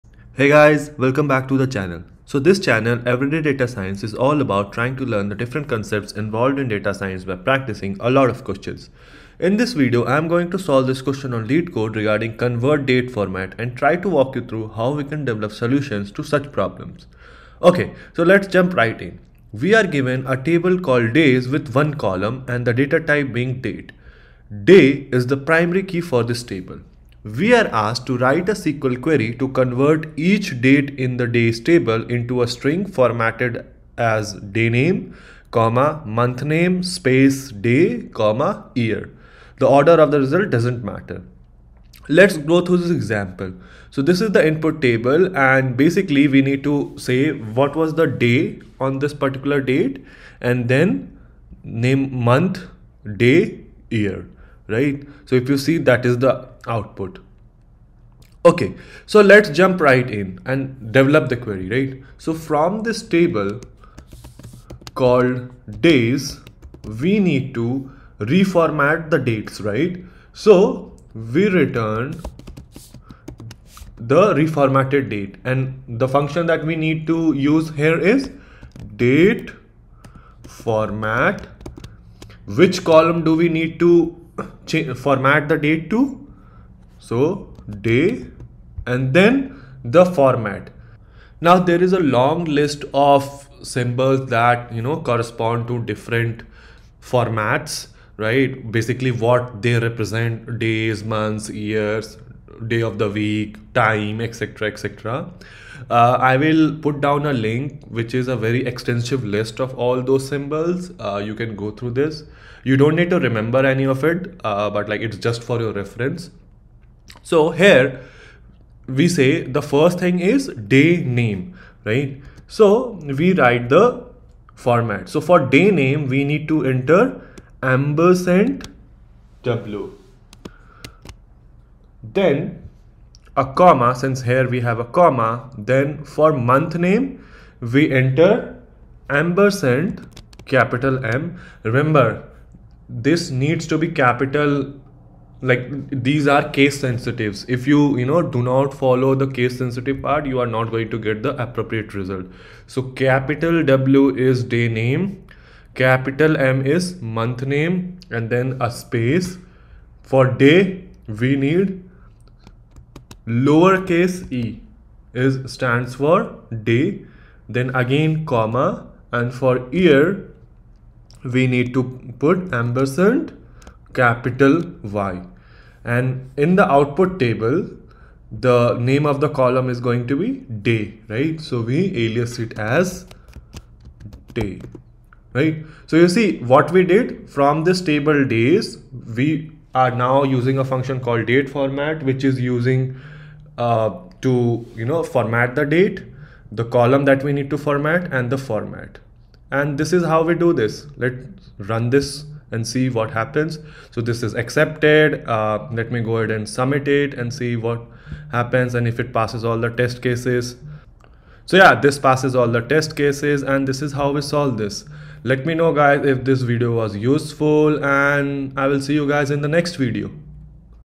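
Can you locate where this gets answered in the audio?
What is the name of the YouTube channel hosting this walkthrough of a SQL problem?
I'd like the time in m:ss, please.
0:03.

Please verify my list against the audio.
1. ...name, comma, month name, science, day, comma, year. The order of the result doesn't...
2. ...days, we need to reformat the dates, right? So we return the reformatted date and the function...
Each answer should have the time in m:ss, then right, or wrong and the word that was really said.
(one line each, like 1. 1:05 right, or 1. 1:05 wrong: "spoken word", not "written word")
1. 0:34 wrong: "space", not "science"
2. 1:05 right.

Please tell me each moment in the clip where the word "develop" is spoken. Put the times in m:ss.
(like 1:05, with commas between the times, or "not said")
0:15, 1:00.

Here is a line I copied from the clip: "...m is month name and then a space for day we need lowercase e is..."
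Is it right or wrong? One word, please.
right.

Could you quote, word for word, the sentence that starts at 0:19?
We are given a table called days with one column and the data type being date.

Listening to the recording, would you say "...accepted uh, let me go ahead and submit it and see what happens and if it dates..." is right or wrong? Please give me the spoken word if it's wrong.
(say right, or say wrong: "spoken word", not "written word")
wrong: "passes", not "dates".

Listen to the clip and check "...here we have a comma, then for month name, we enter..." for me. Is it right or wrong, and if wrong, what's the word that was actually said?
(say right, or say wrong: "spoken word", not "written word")
right.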